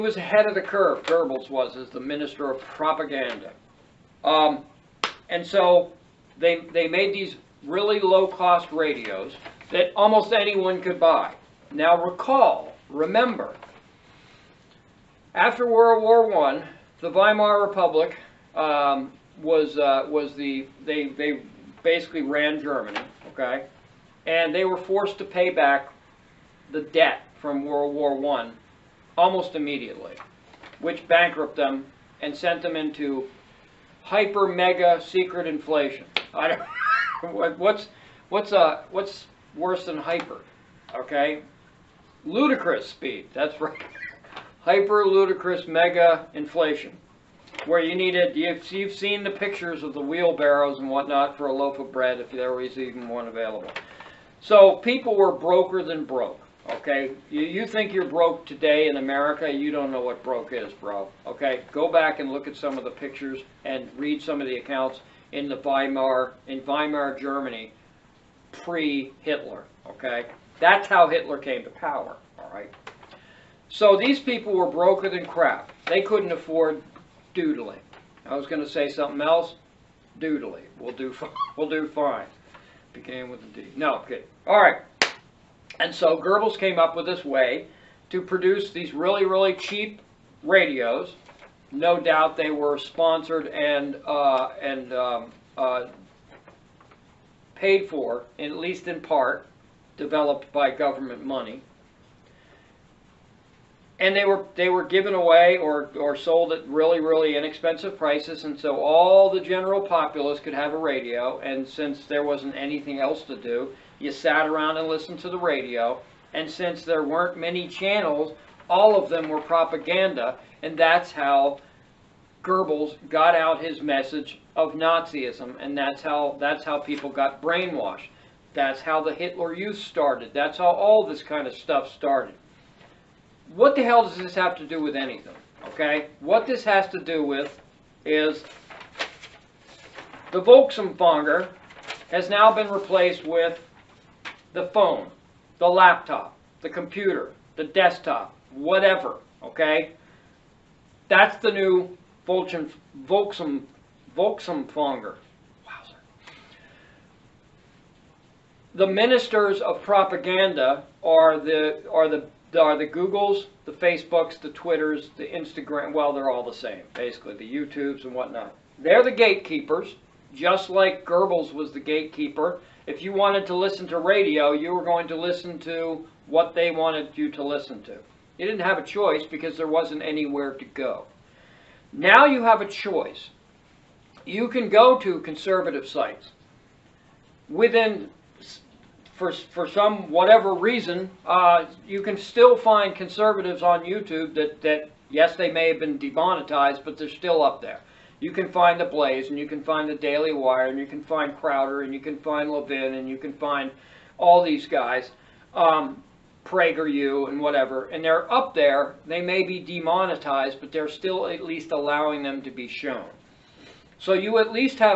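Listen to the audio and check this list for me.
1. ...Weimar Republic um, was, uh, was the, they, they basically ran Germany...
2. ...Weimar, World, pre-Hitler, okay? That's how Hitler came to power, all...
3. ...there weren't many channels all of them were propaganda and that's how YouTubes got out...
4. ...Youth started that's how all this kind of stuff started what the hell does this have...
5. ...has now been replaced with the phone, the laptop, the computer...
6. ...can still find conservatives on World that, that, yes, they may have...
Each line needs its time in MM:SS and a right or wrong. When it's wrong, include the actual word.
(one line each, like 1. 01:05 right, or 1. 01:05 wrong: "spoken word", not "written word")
1. 00:17 right
2. 01:06 wrong: "Germany", not "World"
3. 01:56 wrong: "Goebbels", not "YouTubes"
4. 02:09 right
5. 02:22 right
6. 03:12 wrong: "YouTube", not "World".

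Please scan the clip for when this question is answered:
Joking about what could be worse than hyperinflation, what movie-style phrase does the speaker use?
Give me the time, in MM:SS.
00:42.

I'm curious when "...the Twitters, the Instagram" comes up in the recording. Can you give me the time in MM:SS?
02:44.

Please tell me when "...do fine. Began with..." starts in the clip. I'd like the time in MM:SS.
01:21.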